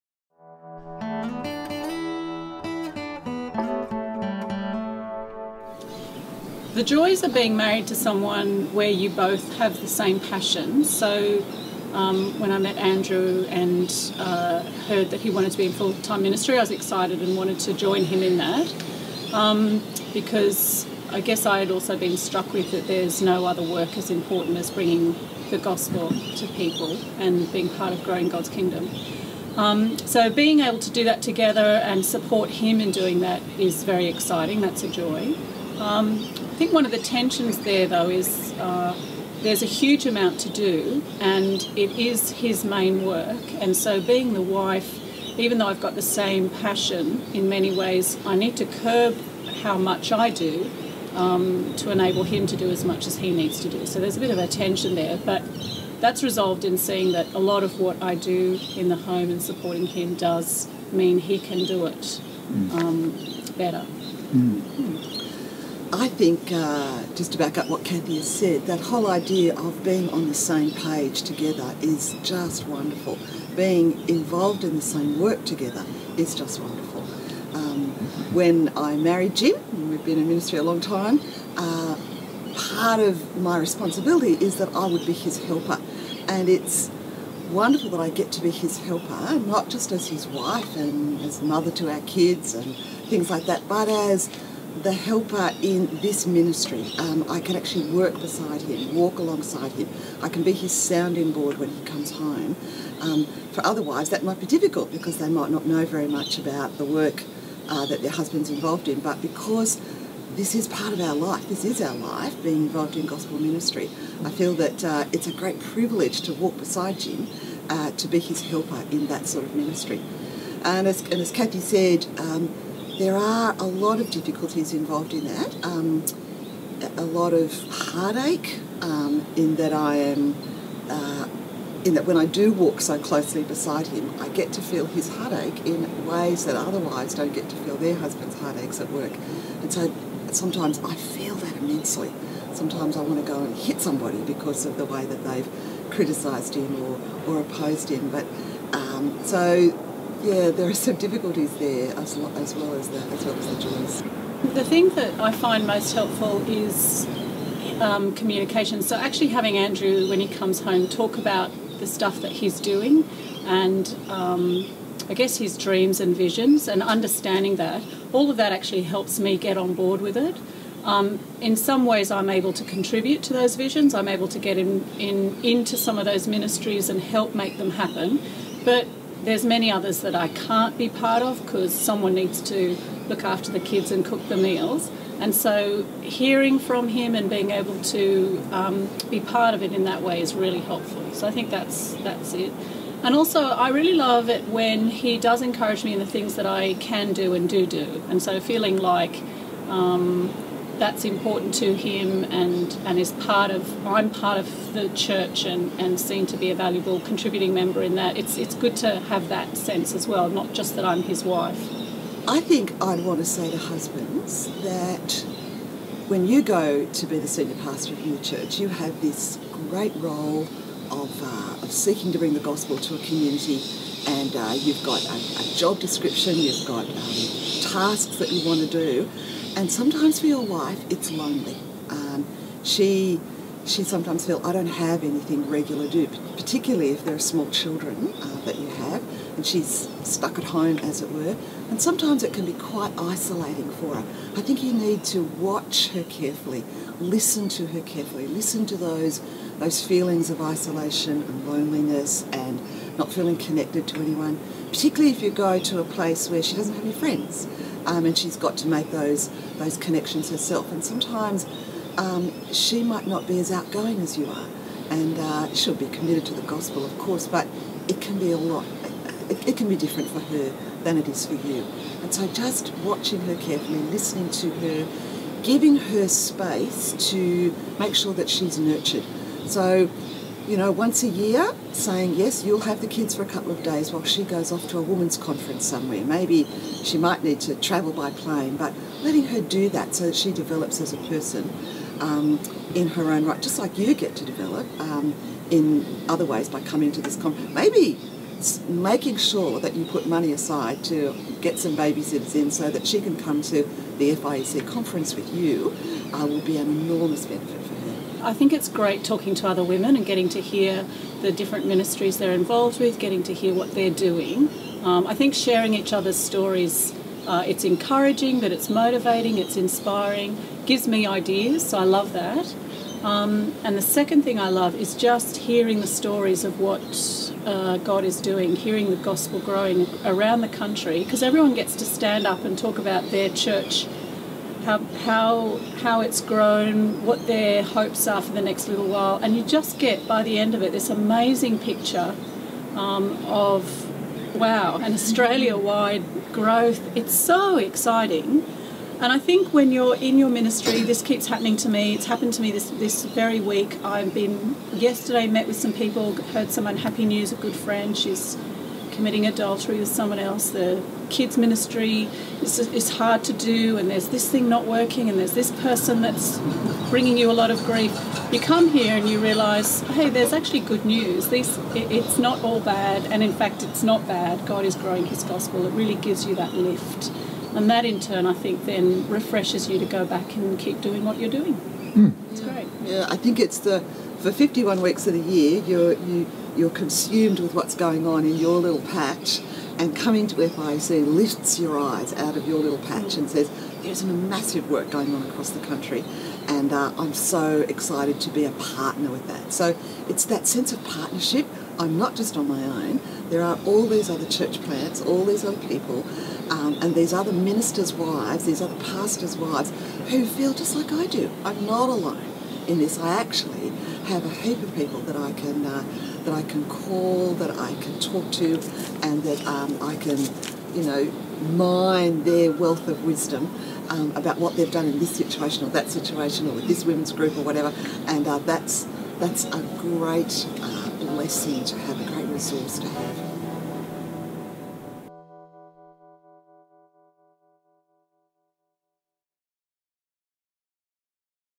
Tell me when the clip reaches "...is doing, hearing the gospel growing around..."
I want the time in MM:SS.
05:28.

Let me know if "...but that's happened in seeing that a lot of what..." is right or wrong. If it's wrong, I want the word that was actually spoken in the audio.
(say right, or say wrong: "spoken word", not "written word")
wrong: "resolved", not "happened".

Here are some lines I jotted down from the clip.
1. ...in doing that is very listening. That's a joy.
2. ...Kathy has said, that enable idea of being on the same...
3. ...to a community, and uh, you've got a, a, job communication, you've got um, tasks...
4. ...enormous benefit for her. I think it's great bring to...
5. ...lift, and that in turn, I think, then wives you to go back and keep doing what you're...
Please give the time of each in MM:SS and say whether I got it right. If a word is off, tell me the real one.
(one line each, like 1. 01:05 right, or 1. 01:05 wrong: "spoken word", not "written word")
1. 00:32 wrong: "exciting", not "listening"
2. 01:07 wrong: "whole", not "enable"
3. 03:42 wrong: "description", not "communication"
4. 05:06 wrong: "talking", not "bring"
5. 06:16 wrong: "refreshes", not "wives".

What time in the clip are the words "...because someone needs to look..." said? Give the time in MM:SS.
03:01.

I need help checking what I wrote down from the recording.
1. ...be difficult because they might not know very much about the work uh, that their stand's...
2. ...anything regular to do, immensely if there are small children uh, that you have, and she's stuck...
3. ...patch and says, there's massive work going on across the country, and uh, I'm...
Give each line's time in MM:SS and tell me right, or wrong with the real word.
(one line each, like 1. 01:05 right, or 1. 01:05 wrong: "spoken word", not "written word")
1. 01:44 wrong: "husband", not "stand"
2. 03:55 wrong: "particularly", not "immensely"
3. 06:32 right.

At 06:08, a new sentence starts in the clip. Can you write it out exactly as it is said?
You come here and you realise, hey, there's actually good news.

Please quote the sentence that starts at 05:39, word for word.
And you just get, by the end of it, this amazing picture um, of wow, an Australia wide growth.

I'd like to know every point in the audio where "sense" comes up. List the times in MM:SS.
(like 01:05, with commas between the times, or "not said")
03:29, 06:40.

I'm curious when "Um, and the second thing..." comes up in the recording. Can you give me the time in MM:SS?
05:23.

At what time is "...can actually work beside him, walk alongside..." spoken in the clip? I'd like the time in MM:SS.
01:37.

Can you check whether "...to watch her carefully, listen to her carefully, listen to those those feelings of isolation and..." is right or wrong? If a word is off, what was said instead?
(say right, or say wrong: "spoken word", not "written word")
right.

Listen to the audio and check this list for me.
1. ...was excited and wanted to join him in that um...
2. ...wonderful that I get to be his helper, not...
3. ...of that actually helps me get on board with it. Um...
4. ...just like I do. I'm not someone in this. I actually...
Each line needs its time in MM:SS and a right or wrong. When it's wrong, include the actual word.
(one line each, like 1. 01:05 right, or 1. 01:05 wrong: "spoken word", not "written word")
1. 00:16 right
2. 01:27 right
3. 02:48 right
4. 06:50 wrong: "alone", not "someone".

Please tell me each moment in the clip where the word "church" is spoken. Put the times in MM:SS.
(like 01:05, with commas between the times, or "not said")
03:24, 03:38, 05:33, 06:44.